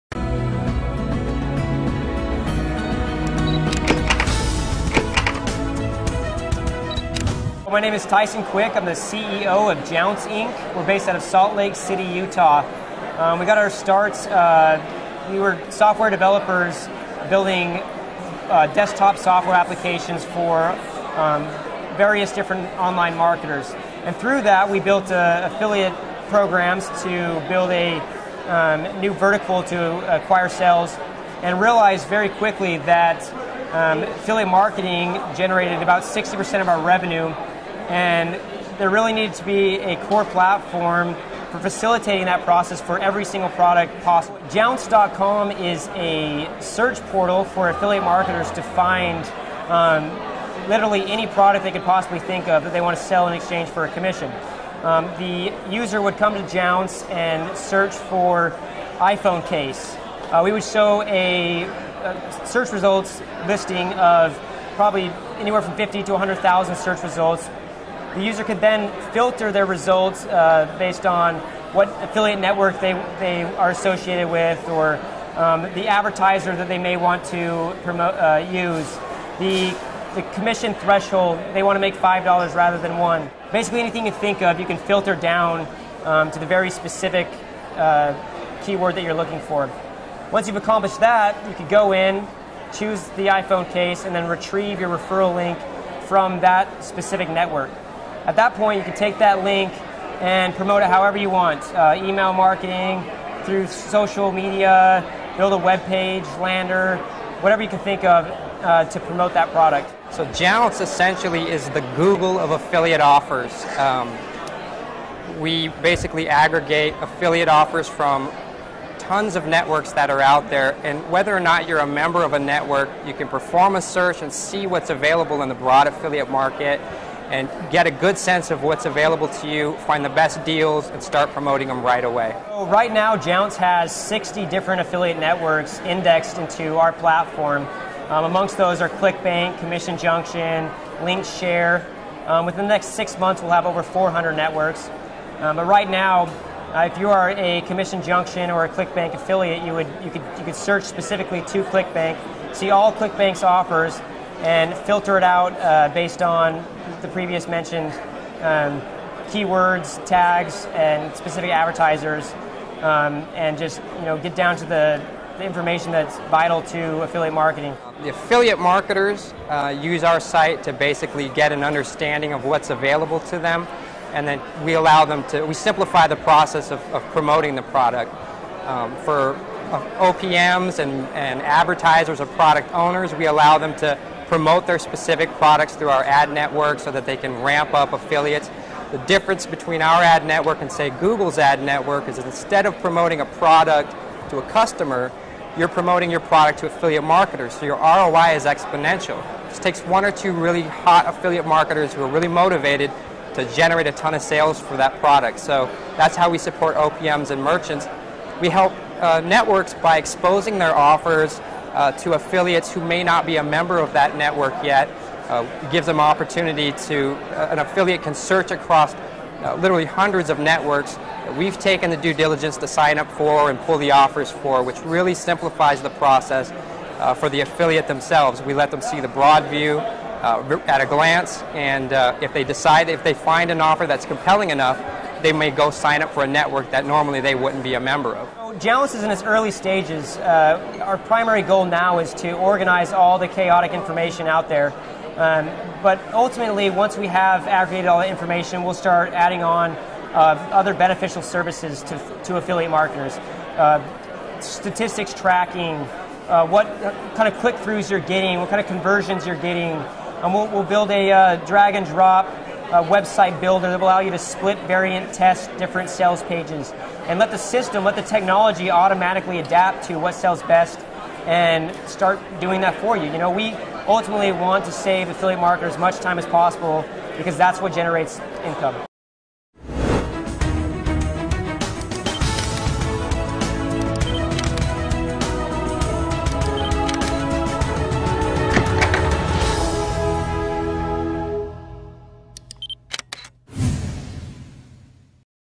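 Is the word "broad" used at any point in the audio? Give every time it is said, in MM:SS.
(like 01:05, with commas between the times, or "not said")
02:05, 03:49.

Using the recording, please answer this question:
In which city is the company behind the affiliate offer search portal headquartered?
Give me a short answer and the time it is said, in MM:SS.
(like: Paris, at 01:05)
Salt Lake City, at 00:11.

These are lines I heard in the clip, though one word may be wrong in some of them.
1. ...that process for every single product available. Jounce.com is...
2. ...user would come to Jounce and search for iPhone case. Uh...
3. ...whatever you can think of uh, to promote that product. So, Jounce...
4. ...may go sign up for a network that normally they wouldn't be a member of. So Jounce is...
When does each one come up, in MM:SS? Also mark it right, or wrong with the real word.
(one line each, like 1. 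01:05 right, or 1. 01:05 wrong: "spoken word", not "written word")
1. 00:42 wrong: "possible", not "available"
2. 00:55 right
3. 01:47 right
4. 03:55 right.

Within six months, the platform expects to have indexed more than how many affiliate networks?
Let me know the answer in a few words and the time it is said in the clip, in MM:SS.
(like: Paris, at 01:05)
400, at 02:23.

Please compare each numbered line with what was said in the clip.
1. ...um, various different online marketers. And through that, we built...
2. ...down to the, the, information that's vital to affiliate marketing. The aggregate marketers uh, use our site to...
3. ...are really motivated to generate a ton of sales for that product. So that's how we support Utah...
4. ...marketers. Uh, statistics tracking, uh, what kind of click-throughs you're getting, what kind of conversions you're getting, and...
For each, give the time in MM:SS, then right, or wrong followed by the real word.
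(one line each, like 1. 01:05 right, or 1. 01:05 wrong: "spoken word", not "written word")
1. 00:21 right
2. 02:44 wrong: "affiliate", not "aggregate"
3. 03:22 wrong: "OPMs", not "Utah"
4. 04:12 right.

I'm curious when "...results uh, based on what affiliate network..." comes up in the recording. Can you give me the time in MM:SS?
01:09.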